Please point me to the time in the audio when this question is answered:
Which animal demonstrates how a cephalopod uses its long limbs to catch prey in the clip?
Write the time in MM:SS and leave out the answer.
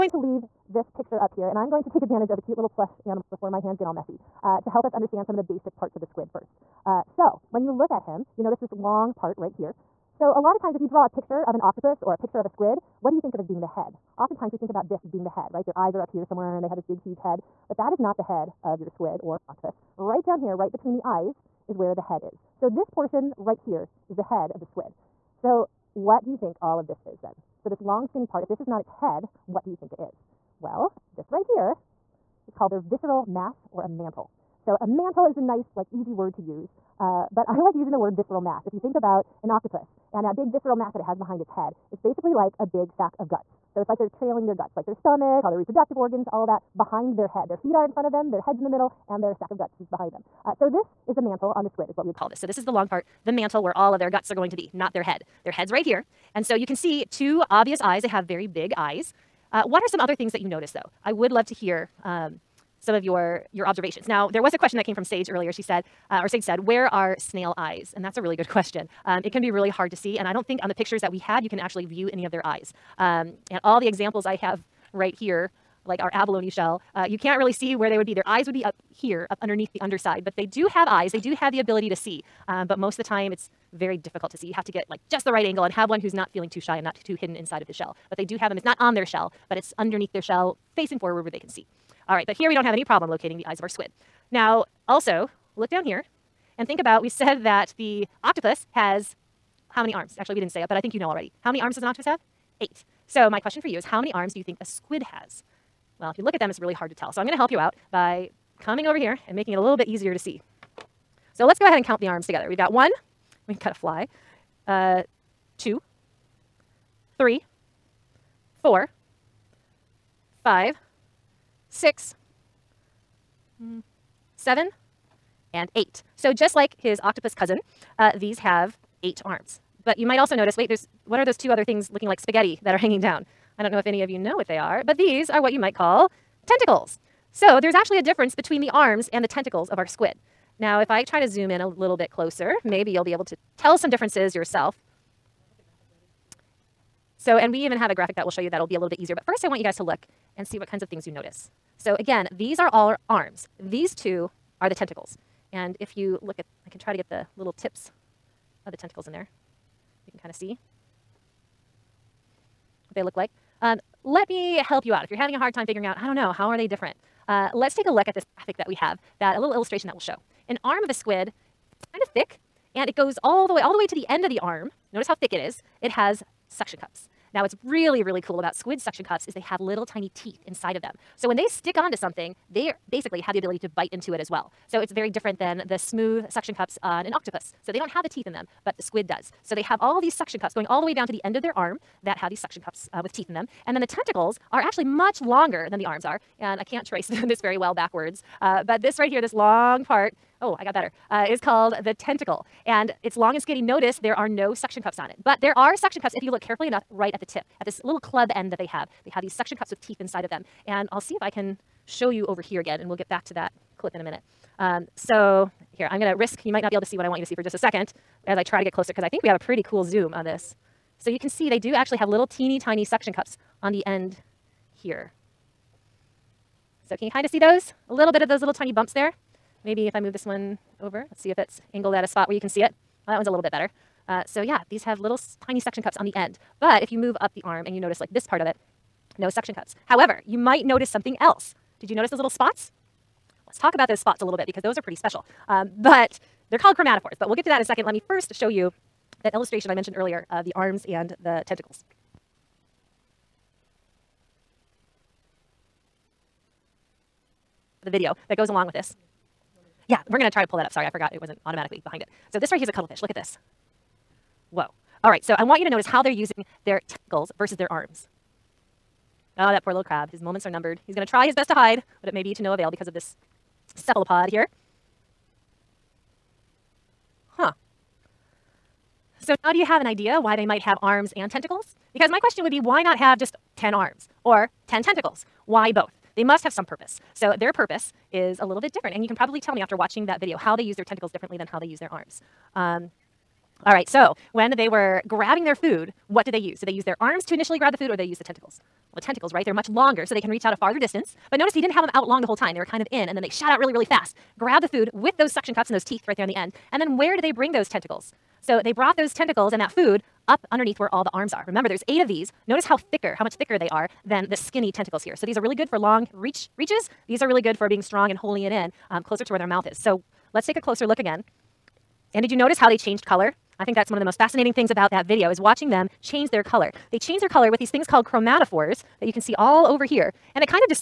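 04:22.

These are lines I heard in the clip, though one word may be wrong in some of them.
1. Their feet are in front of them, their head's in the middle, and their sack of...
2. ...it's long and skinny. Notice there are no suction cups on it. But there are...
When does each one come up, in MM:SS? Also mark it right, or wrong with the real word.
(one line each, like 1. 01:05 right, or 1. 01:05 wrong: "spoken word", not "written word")
1. 00:47 right
2. 03:23 right.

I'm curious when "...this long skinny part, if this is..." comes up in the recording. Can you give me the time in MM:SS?
00:27.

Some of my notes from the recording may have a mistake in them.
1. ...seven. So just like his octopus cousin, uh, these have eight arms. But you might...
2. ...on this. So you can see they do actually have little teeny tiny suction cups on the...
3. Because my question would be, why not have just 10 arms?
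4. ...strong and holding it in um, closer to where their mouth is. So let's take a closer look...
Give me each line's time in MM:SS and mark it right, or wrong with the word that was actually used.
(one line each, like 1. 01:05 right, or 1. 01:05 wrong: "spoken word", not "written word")
1. 02:05 wrong: "eight", not "seven"
2. 03:40 right
3. 04:41 right
4. 05:17 right.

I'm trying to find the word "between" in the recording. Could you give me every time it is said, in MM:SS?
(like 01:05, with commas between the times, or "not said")
00:20, 02:18.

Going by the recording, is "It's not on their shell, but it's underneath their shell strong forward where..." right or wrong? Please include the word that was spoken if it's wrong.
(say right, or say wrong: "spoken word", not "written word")
wrong: "facing", not "strong".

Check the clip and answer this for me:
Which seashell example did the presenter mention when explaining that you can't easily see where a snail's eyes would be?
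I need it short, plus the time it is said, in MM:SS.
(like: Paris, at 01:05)
abalone shell, at 01:16.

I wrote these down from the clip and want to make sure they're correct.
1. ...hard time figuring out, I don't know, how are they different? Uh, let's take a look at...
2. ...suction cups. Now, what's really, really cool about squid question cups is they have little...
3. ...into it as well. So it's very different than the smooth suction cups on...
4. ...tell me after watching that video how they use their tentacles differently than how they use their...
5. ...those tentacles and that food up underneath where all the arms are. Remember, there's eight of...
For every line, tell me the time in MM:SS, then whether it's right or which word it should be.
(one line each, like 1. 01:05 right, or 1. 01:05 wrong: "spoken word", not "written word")
1. 02:45 right
2. 02:56 wrong: "suction", not "question"
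3. 03:03 right
4. 04:49 right
5. 05:08 right.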